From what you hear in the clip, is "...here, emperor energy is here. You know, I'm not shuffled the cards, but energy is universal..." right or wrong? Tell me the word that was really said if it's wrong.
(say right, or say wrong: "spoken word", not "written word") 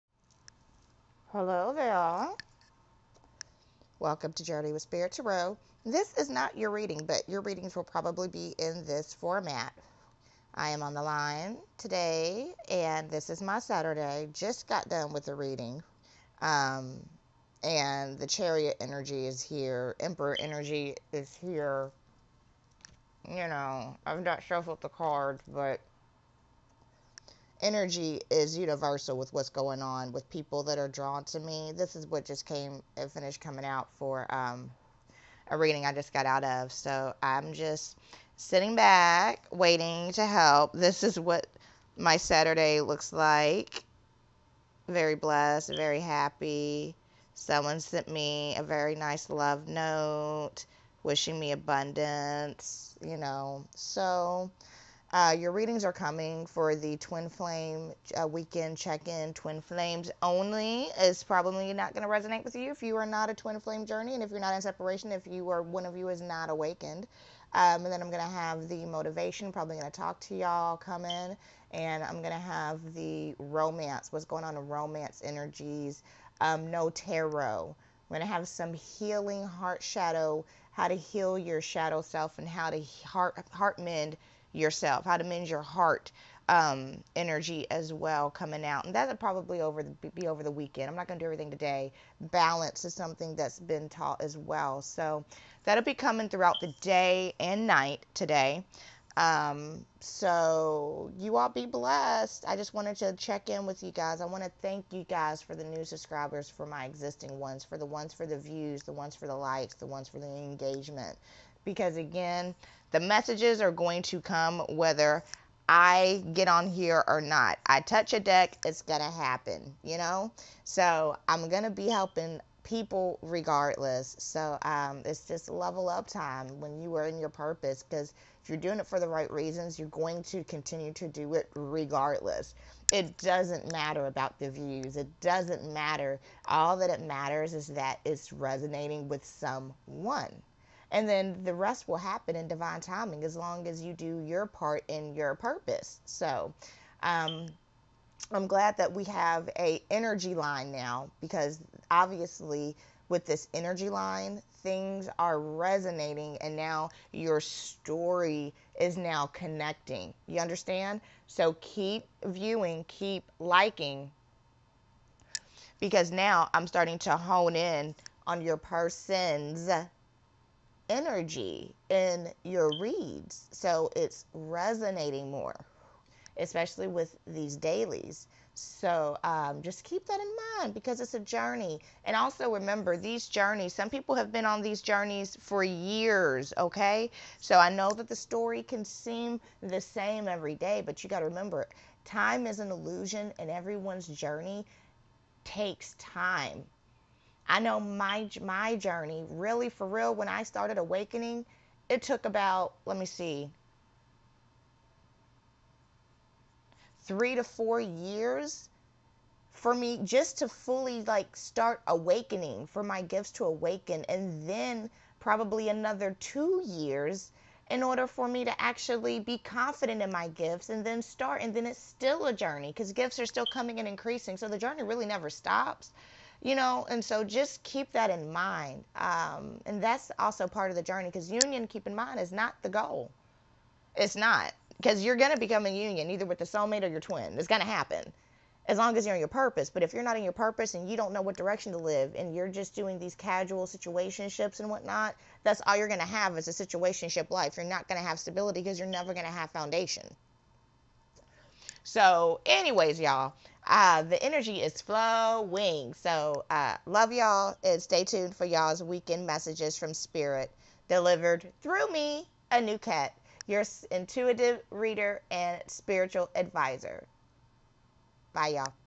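right.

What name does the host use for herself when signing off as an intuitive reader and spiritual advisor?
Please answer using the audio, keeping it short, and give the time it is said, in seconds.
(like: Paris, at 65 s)
Anuket, at 262 s.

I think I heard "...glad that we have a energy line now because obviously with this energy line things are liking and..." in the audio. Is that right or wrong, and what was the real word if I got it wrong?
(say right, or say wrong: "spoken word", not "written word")
wrong: "resonating", not "liking".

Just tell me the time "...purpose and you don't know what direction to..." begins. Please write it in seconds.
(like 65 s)
240 s.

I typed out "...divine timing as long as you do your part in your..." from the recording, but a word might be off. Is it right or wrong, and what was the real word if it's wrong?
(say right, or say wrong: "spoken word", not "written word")
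right.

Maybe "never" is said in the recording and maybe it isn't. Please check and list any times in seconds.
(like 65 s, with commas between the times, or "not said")
225 s, 248 s.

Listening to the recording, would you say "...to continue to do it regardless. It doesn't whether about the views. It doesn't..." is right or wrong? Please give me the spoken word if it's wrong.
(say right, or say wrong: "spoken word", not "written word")
wrong: "matter", not "whether".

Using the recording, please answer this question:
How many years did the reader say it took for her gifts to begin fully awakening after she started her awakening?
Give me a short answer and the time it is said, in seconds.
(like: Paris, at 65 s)
3 to 4, at 207 s.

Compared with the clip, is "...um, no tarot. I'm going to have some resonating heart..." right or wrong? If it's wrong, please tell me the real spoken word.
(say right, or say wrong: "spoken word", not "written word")
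wrong: "healing", not "resonating".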